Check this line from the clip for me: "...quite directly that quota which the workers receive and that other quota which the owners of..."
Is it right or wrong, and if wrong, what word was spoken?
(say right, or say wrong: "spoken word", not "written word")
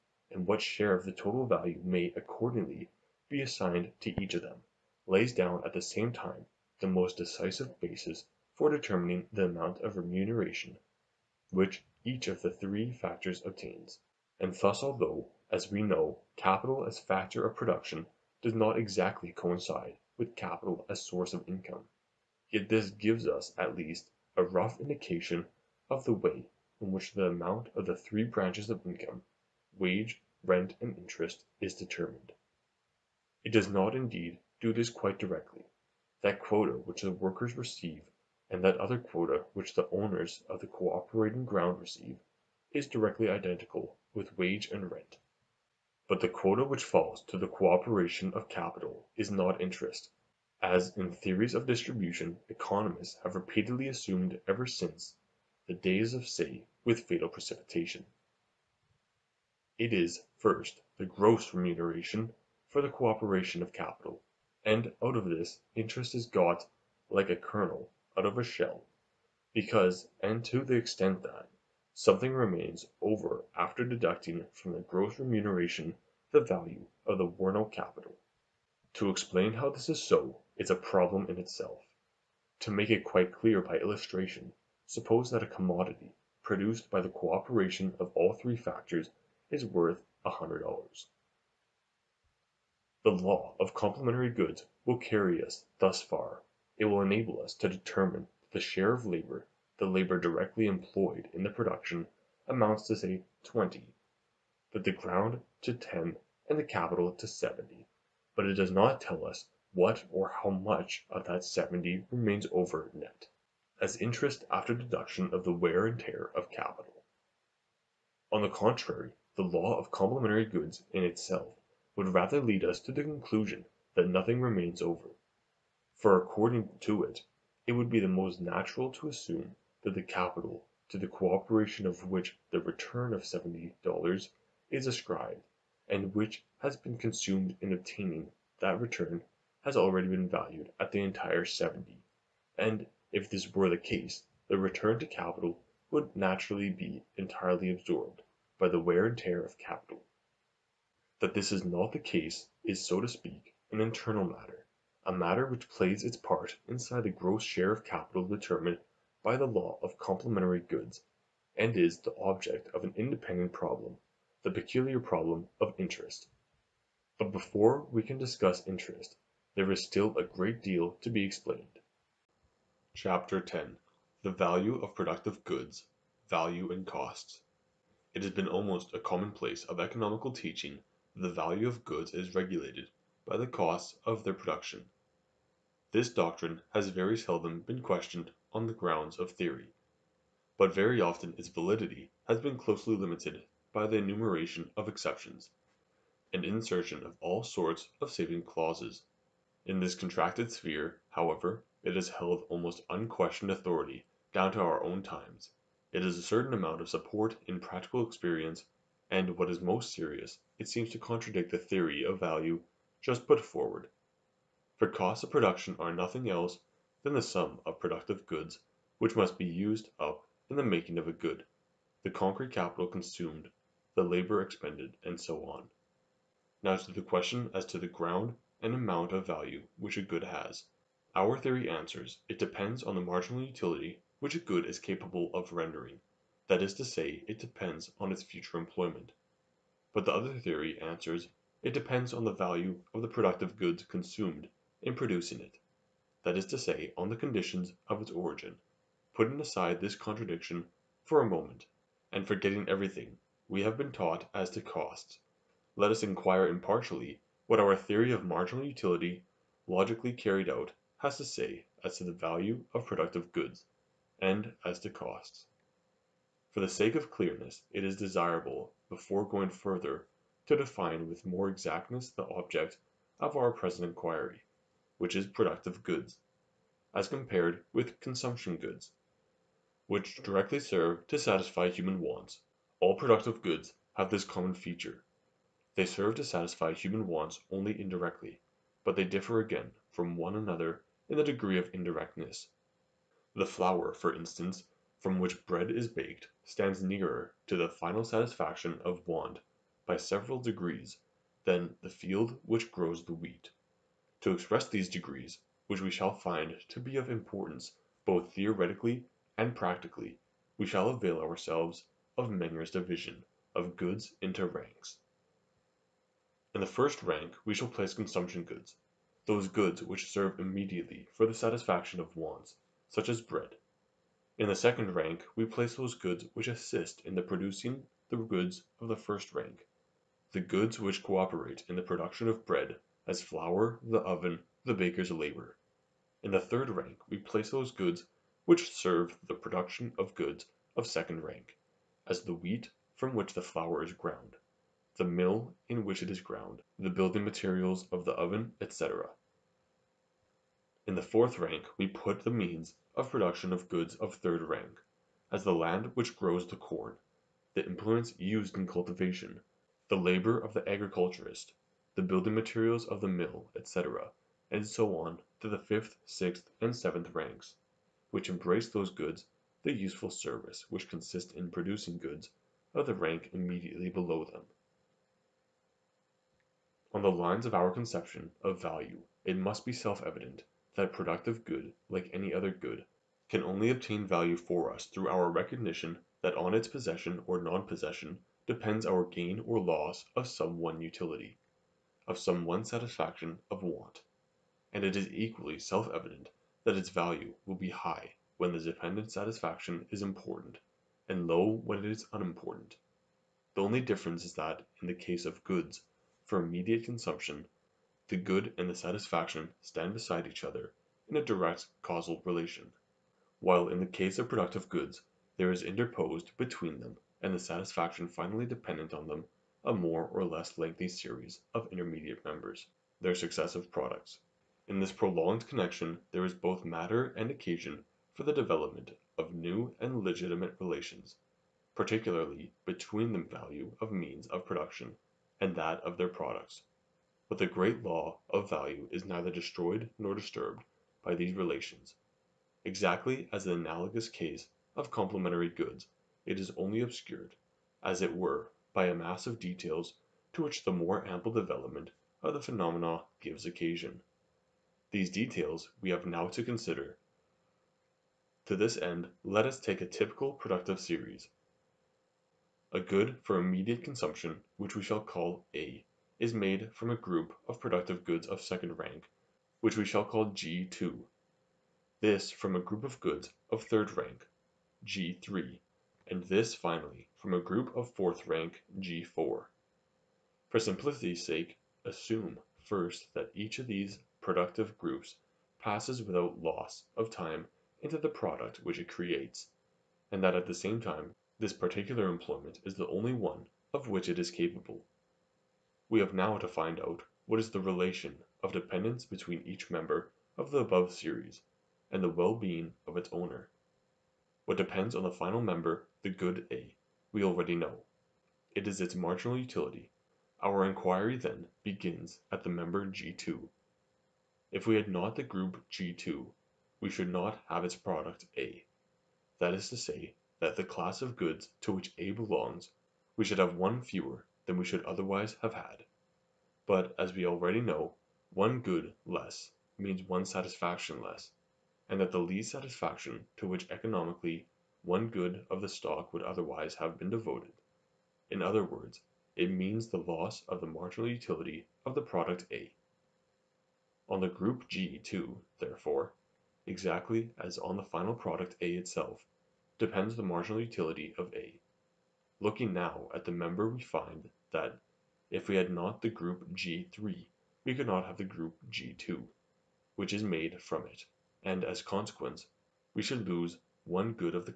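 right.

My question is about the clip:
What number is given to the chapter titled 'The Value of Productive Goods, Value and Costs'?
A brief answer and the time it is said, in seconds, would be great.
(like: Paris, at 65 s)
10, at 173 s.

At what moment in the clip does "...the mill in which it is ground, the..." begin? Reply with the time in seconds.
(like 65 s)
344 s.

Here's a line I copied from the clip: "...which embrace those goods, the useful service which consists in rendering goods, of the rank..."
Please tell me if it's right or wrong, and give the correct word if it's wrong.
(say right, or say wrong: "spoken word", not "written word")
wrong: "producing", not "rendering".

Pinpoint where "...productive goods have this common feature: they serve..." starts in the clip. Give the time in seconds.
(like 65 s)
282 s.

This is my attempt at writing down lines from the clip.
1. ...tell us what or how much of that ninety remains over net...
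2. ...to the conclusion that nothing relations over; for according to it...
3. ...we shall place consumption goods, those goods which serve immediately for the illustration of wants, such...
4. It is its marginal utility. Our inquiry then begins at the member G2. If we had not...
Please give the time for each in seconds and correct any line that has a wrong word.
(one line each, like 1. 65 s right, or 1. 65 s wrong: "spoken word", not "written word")
1. 109 s wrong: "seventy", not "ninety"
2. 122 s wrong: "remains", not "relations"
3. 317 s wrong: "satisfaction", not "illustration"
4. 508 s right.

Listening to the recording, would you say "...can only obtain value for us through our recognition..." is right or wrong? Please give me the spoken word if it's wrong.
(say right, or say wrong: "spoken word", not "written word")
right.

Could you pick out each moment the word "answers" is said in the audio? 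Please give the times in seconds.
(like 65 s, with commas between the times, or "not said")
231 s, 240 s.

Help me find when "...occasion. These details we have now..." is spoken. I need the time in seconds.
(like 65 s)
453 s.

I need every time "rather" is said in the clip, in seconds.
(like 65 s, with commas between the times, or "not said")
122 s.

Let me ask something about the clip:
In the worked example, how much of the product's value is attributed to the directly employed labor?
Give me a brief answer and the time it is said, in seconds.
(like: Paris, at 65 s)
20, at 103 s.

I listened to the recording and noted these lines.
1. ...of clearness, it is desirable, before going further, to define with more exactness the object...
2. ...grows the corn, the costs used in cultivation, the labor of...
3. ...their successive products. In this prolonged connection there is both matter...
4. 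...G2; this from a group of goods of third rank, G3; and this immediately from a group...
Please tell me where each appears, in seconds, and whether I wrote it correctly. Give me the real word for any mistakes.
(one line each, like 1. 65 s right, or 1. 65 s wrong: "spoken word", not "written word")
1. 266 s right
2. 356 s wrong: "implements", not "costs"
3. 423 s right
4. 470 s wrong: "finally", not "immediately".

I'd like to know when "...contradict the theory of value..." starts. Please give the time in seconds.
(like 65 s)
210 s.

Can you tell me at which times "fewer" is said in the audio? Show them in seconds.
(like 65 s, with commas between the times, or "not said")
523 s.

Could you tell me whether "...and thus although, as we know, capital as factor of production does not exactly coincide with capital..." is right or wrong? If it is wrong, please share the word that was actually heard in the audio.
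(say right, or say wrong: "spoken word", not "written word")
right.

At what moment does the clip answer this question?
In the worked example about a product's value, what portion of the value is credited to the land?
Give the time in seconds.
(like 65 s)
105 s.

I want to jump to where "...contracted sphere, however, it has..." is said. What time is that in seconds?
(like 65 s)
199 s.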